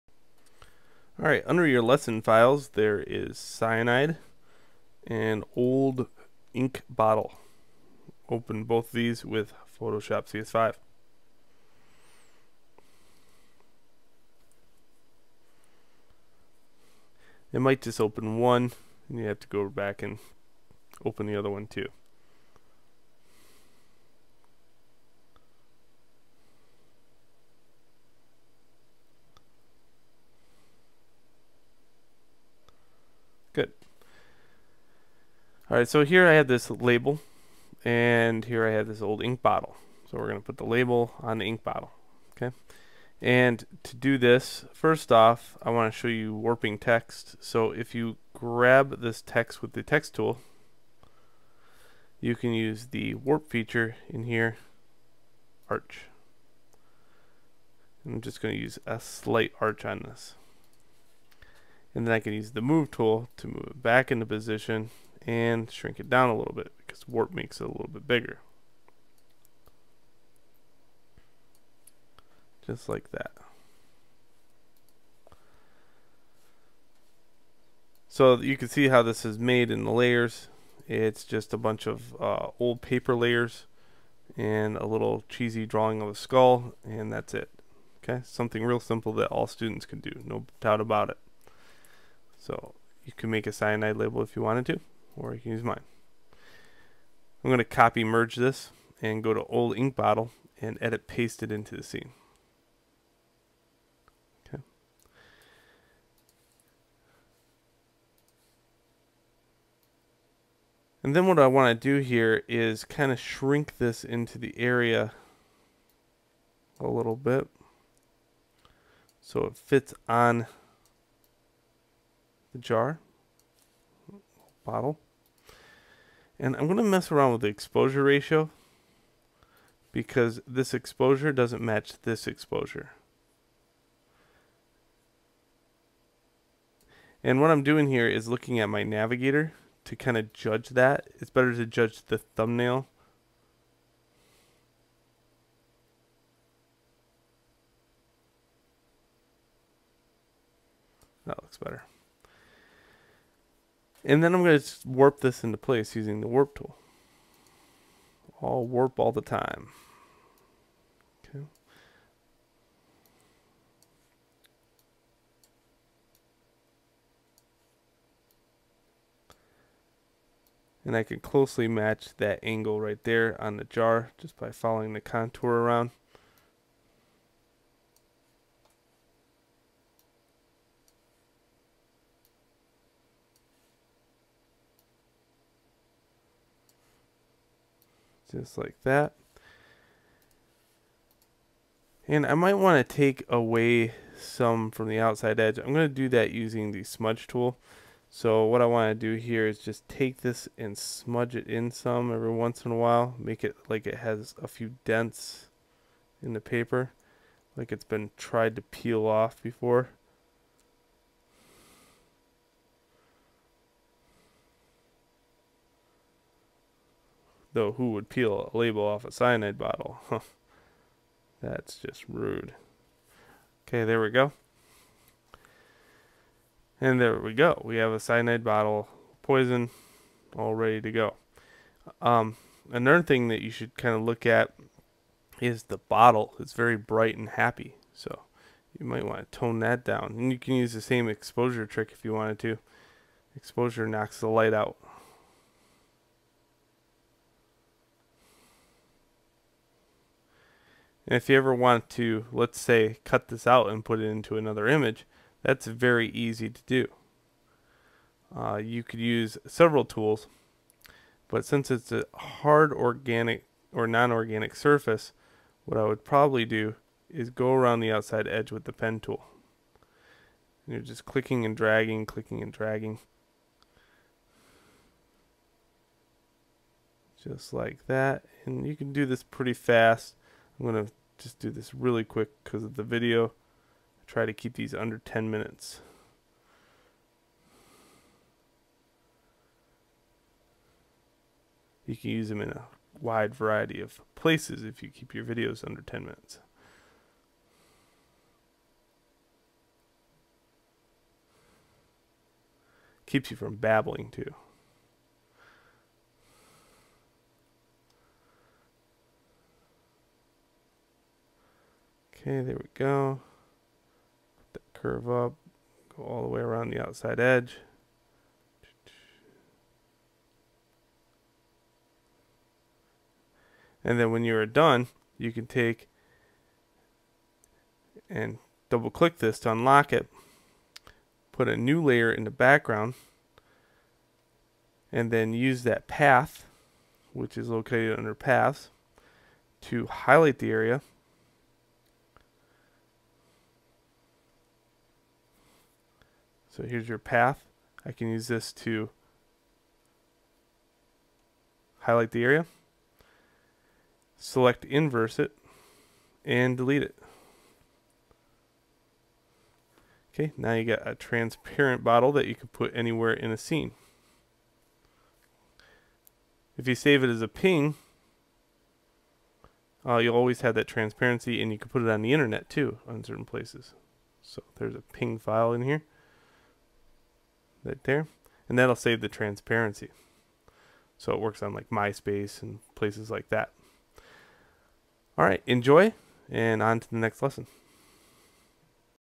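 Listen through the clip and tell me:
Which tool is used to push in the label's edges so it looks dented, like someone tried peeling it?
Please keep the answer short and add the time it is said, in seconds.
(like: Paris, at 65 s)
Smudge tool, at 196 s.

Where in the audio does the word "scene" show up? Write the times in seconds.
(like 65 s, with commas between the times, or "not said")
101 s, 363 s.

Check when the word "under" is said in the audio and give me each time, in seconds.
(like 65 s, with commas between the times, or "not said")
1 s, 284 s, 295 s, 337 s.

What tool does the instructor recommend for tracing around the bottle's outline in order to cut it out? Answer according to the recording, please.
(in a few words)
Pen tool.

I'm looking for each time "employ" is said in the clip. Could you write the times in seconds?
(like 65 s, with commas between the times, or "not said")
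not said.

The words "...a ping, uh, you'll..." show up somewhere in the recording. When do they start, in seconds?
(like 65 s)
367 s.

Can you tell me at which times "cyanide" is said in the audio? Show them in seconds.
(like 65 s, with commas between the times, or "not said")
3 s, 93 s, 219 s, 227 s.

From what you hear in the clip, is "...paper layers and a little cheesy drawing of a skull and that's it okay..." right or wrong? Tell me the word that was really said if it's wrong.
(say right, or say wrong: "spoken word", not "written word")
right.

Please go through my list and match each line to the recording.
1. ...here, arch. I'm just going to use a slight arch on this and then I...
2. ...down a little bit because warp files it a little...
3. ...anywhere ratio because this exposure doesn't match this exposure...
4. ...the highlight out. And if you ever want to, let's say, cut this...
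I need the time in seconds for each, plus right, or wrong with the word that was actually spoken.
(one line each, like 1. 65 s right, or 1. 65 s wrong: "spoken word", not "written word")
1. 54 s right
2. 66 s wrong: "makes", not "files"
3. 127 s wrong: "exposure", not "anywhere"
4. 244 s wrong: "light", not "highlight".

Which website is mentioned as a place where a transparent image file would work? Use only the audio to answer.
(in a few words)
MySpace.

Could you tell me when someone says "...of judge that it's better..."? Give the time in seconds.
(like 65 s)
140 s.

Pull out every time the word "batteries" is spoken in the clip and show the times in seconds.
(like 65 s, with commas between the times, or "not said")
not said.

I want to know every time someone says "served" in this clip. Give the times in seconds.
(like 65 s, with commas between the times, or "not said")
not said.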